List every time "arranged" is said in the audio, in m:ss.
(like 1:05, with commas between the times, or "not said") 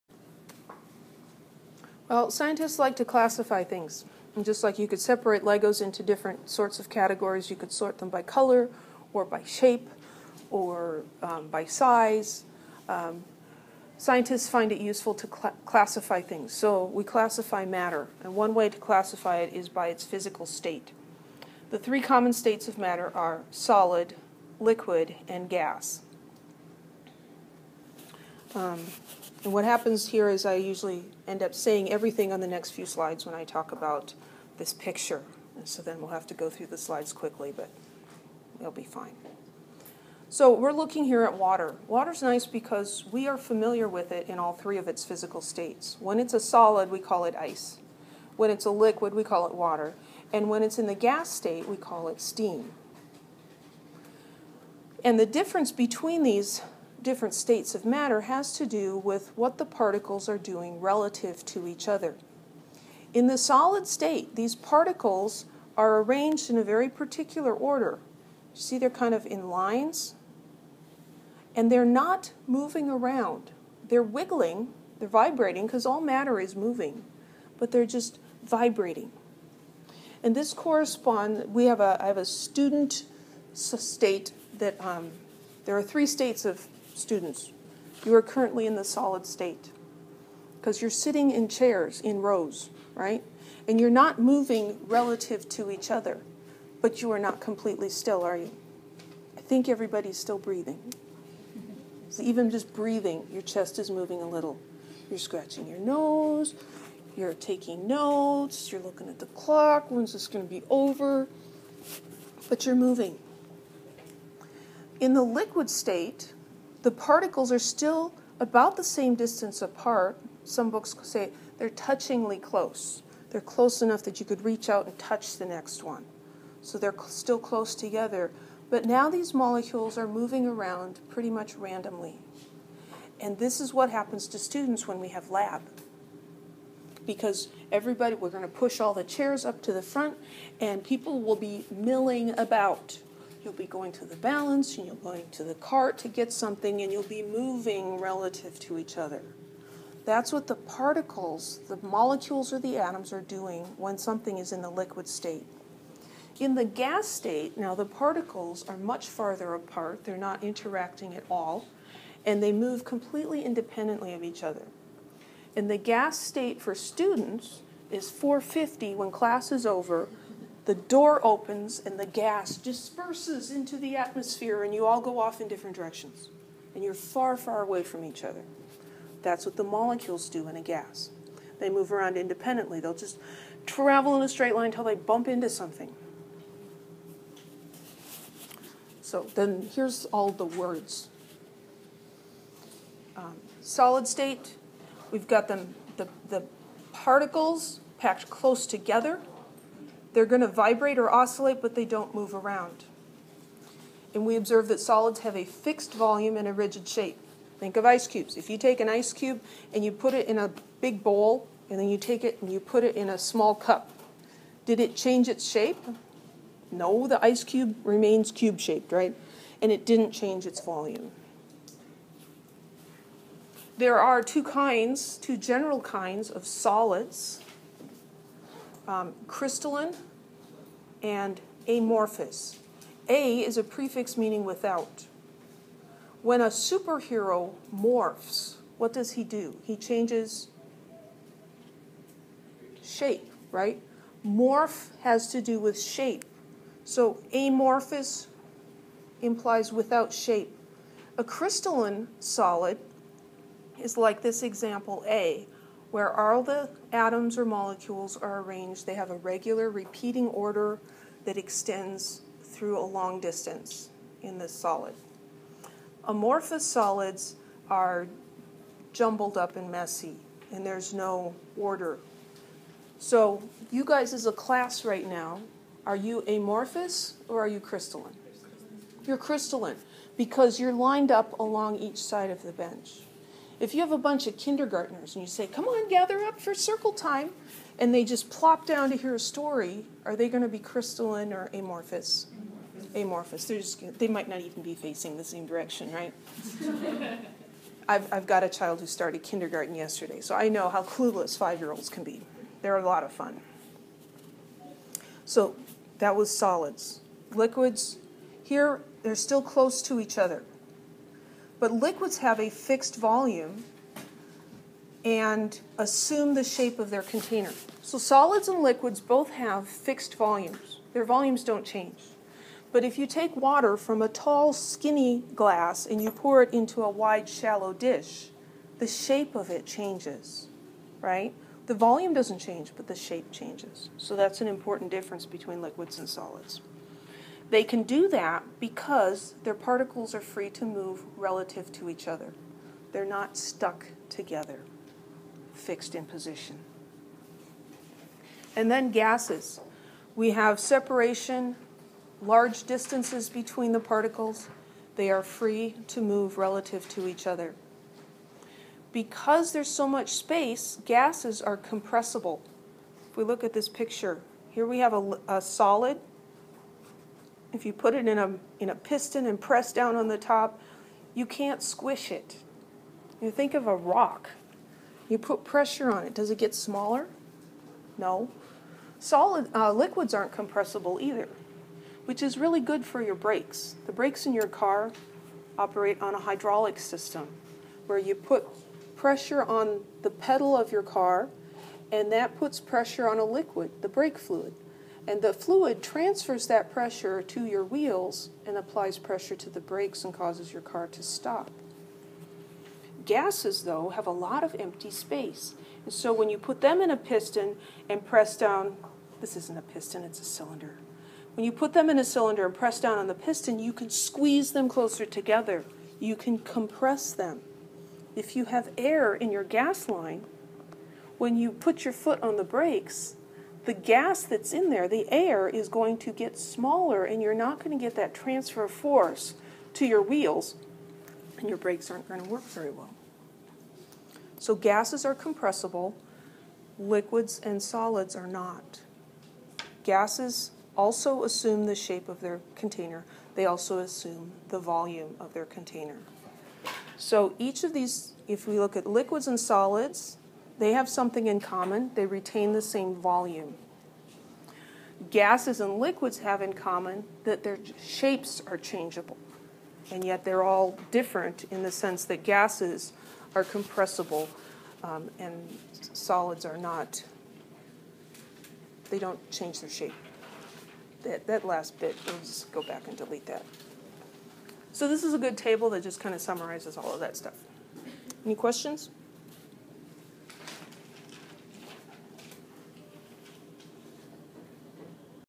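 1:06, 4:18.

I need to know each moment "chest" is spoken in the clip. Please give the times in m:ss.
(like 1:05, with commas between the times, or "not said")
1:43.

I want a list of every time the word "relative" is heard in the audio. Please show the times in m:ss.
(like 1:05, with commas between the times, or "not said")
1:00, 1:34, 2:27, 5:41, 5:56.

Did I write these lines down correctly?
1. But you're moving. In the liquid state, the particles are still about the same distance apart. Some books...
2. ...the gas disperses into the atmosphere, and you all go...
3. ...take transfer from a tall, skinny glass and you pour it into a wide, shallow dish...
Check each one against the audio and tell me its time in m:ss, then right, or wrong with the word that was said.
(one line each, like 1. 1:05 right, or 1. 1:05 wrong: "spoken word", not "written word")
1. 1:52 right
2. 2:51 right
3. 5:23 wrong: "water", not "transfer".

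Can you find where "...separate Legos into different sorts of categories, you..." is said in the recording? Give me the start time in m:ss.
0:04.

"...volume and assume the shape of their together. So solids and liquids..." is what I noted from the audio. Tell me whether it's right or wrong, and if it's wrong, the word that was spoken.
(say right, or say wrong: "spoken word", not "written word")
wrong: "container", not "together".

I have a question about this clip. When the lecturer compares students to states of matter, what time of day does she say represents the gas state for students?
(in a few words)
4:50.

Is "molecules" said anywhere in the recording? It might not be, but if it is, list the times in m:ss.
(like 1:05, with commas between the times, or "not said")
2:09, 2:31, 2:59, 4:17.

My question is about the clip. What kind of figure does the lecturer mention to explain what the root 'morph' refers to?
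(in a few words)
A superhero.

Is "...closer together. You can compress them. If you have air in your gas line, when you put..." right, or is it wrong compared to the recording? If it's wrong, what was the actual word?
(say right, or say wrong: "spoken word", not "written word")
right.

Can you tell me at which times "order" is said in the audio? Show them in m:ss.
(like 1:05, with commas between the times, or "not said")
1:07, 4:20, 4:31.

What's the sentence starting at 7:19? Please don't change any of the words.
Gases also assume the shape of their container.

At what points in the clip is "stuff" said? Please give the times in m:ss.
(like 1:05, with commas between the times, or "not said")
7:57.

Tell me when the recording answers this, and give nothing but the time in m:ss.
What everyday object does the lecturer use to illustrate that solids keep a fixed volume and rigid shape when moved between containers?
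3:27.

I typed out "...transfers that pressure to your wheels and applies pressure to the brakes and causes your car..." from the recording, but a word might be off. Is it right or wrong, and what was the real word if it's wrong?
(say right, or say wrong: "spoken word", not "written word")
right.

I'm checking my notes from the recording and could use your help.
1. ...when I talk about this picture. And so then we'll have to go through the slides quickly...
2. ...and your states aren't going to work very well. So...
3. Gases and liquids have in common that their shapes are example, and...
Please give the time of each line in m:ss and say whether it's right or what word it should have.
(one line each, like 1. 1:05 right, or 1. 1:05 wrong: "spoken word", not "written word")
1. 0:33 right
2. 7:11 wrong: "brakes", not "states"
3. 7:35 wrong: "changeable", not "example".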